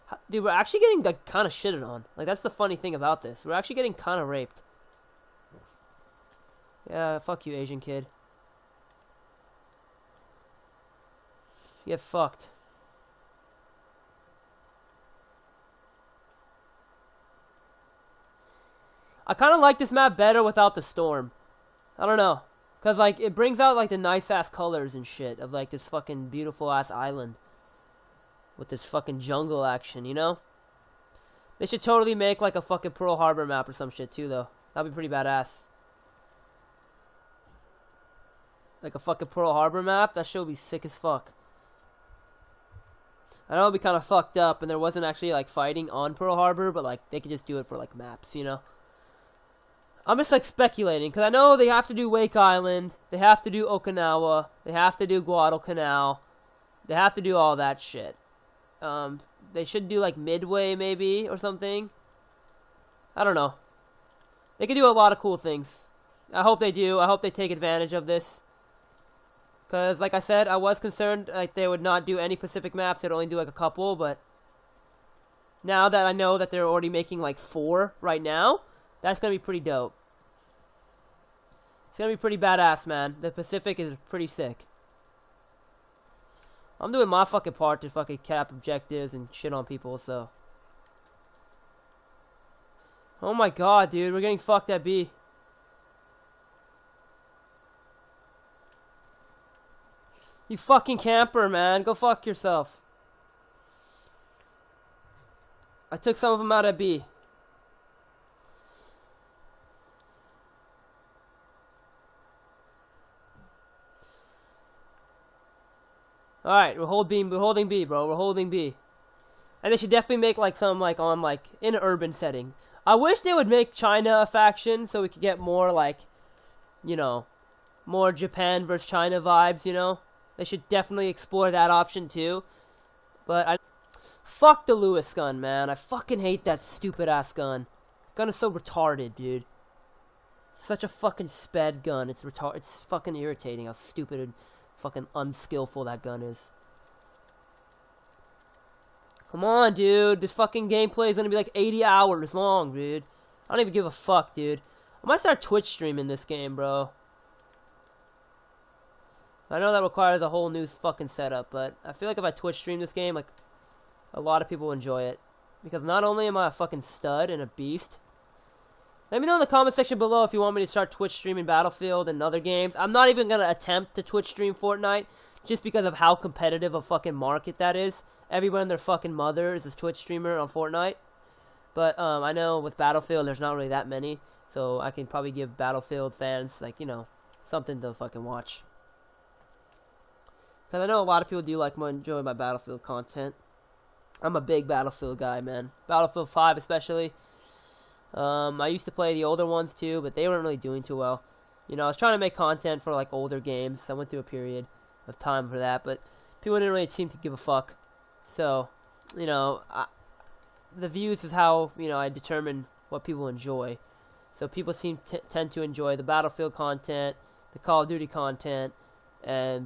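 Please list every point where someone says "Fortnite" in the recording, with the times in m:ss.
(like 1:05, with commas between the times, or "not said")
2:54, 3:00.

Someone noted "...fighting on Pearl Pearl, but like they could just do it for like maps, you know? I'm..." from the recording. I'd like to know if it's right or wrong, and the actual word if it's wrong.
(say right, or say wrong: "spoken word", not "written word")
wrong: "Harbor", not "Pearl".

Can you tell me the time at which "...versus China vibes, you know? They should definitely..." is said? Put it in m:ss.
2:08.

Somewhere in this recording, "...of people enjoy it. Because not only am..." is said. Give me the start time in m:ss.
2:44.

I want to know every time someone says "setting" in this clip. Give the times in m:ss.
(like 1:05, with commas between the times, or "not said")
2:02.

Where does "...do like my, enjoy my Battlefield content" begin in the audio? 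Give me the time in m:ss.
3:11.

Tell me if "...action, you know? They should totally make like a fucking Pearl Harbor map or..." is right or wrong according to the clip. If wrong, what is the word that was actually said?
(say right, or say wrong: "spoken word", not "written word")
right.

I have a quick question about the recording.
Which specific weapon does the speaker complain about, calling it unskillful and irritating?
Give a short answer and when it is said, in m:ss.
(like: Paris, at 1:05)
Lewis gun, at 2:14.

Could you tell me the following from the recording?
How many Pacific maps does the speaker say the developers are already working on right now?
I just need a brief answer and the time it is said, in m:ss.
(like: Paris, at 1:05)
4, at 1:17.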